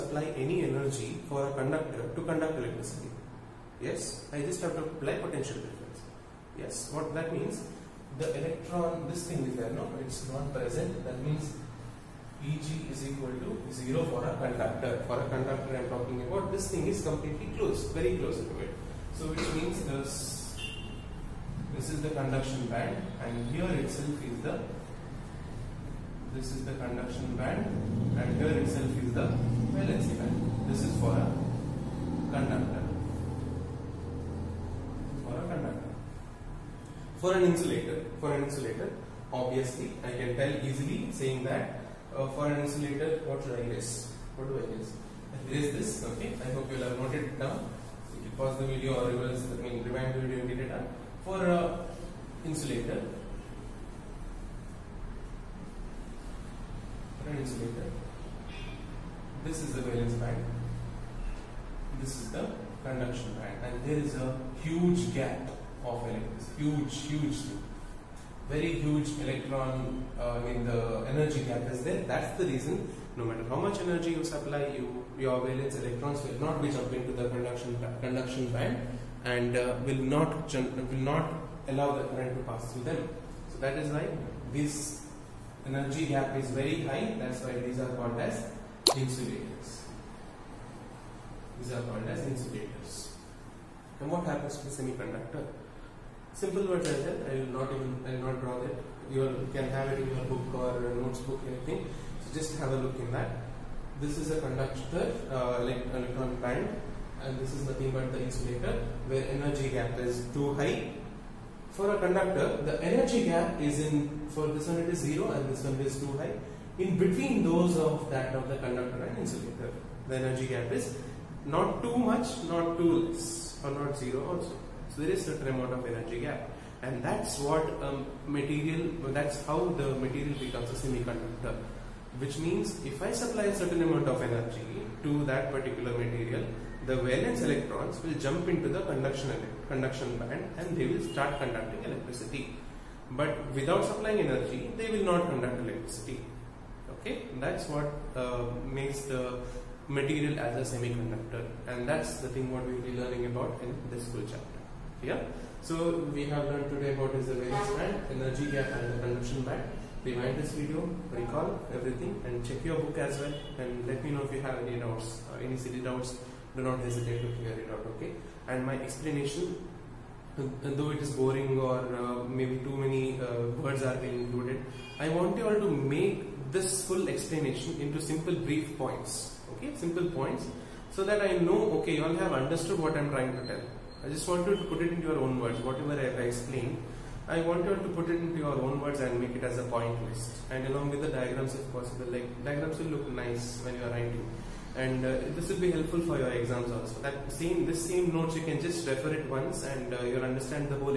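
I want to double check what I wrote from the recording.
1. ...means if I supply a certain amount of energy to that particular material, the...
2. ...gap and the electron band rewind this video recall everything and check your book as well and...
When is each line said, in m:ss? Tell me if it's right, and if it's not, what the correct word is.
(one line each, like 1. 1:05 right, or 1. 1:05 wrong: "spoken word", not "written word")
1. 2:12 right
2. 2:38 wrong: "conduction", not "electron".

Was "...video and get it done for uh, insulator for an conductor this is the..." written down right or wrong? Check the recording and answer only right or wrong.
wrong.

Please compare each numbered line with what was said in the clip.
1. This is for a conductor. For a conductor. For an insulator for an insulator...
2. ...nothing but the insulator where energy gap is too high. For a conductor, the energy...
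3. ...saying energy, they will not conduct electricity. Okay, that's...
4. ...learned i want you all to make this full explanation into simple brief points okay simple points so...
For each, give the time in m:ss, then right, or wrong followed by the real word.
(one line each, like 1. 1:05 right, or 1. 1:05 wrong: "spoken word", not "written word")
1. 0:30 right
2. 1:47 right
3. 2:23 wrong: "supplying", not "saying"
4. 2:54 wrong: "included", not "learned".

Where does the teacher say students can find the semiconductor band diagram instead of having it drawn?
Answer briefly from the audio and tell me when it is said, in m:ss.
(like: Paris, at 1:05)
book or notebook, at 1:40.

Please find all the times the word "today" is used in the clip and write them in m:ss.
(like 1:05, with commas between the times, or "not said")
2:36.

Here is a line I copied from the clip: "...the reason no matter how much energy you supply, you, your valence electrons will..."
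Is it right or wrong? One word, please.
right.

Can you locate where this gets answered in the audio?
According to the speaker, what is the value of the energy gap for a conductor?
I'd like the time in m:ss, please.
0:12.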